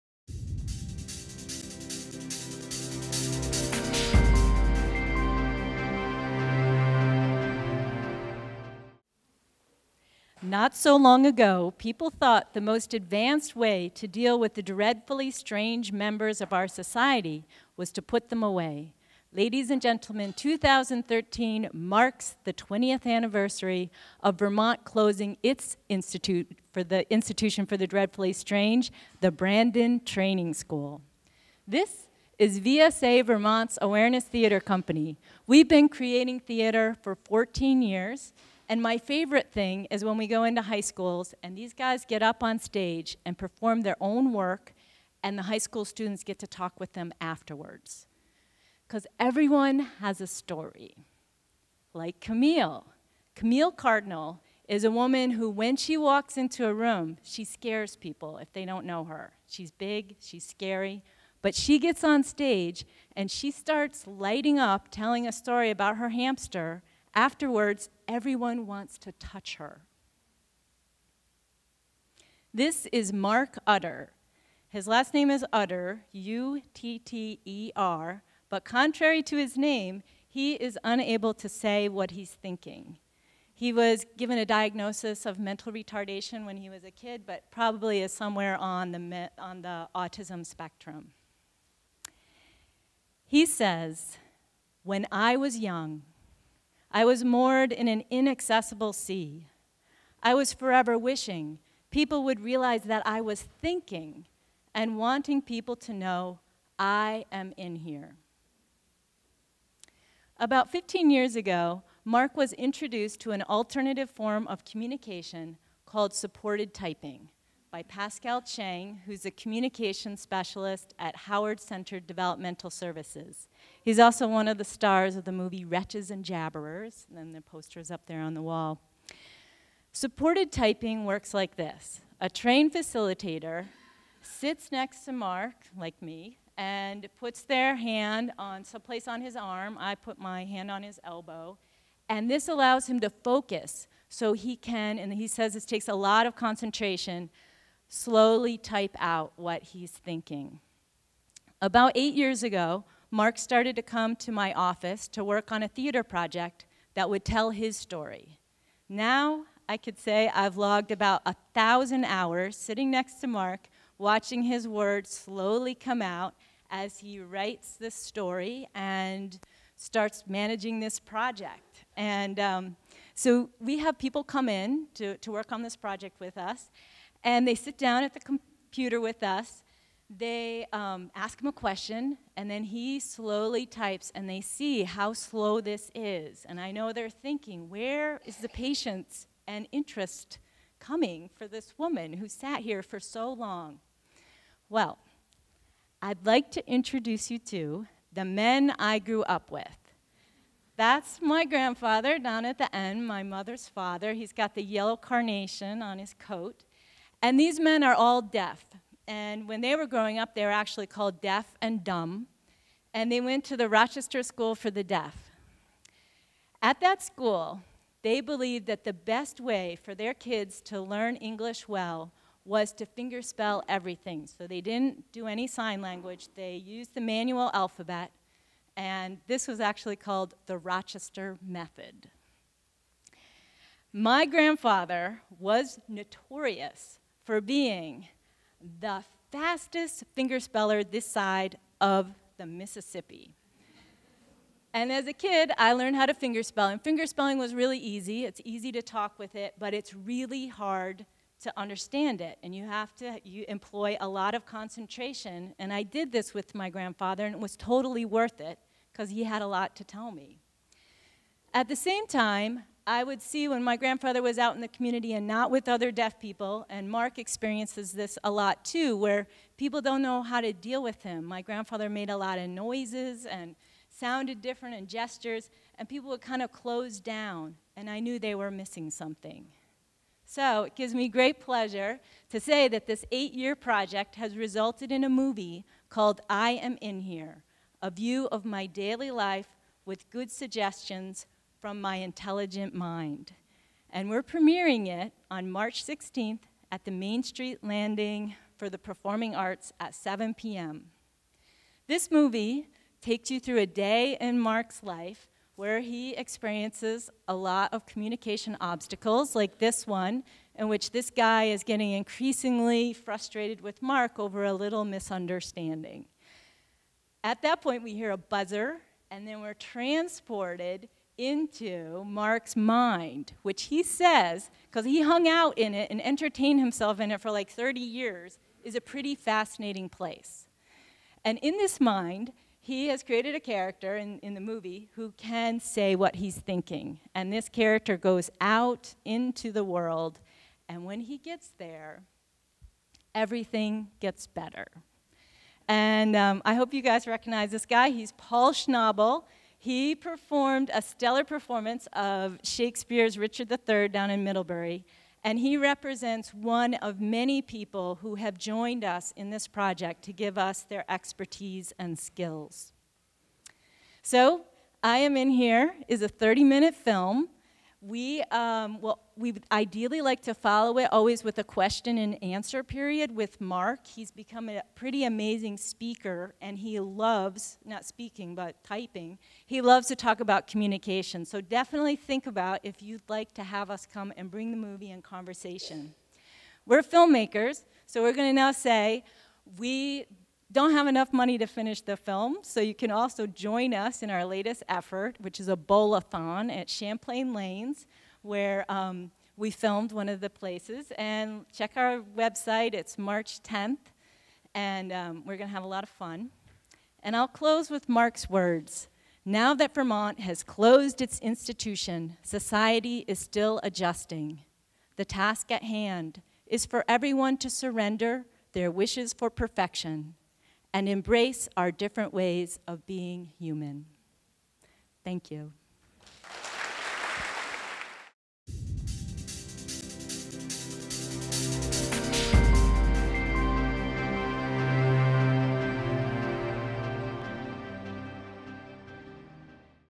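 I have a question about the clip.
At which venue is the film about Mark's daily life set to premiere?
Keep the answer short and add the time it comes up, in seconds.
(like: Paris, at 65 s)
Main Street Landing, at 296 s.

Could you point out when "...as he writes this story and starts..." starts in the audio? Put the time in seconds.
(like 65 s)
166 s.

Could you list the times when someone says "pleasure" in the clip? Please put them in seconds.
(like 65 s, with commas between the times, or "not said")
281 s.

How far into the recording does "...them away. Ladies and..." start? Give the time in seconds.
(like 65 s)
18 s.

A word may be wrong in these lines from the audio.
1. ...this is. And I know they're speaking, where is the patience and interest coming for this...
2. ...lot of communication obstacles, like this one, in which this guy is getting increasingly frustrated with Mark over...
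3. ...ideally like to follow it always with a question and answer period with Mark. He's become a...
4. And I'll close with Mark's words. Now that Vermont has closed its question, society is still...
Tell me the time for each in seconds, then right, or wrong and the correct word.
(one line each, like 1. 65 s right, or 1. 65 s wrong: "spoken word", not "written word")
1. 185 s wrong: "thinking", not "speaking"
2. 307 s right
3. 369 s right
4. 407 s wrong: "institution", not "question".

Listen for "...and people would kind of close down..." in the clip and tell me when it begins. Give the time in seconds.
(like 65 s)
275 s.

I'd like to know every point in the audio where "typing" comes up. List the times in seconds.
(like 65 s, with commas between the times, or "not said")
116 s, 130 s, 378 s.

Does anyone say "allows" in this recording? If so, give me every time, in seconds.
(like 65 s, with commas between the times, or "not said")
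142 s.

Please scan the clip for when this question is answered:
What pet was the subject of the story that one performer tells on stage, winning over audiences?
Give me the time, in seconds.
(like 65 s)
66 s.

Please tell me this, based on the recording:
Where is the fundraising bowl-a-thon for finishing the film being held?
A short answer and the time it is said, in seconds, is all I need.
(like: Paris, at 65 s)
Champlain Lanes, at 396 s.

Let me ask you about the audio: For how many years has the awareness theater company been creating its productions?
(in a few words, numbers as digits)
14.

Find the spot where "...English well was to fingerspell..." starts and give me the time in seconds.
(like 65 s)
221 s.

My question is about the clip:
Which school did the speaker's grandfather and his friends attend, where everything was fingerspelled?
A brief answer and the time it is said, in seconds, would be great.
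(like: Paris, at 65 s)
Rochester School for the Deaf, at 213 s.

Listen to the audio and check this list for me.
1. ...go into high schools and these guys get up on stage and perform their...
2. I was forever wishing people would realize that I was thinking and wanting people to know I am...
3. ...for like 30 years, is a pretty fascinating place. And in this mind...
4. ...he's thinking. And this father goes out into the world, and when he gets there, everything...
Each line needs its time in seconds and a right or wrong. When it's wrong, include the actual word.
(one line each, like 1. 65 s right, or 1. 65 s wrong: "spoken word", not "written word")
1. 40 s right
2. 100 s right
3. 327 s right
4. 336 s wrong: "character", not "father".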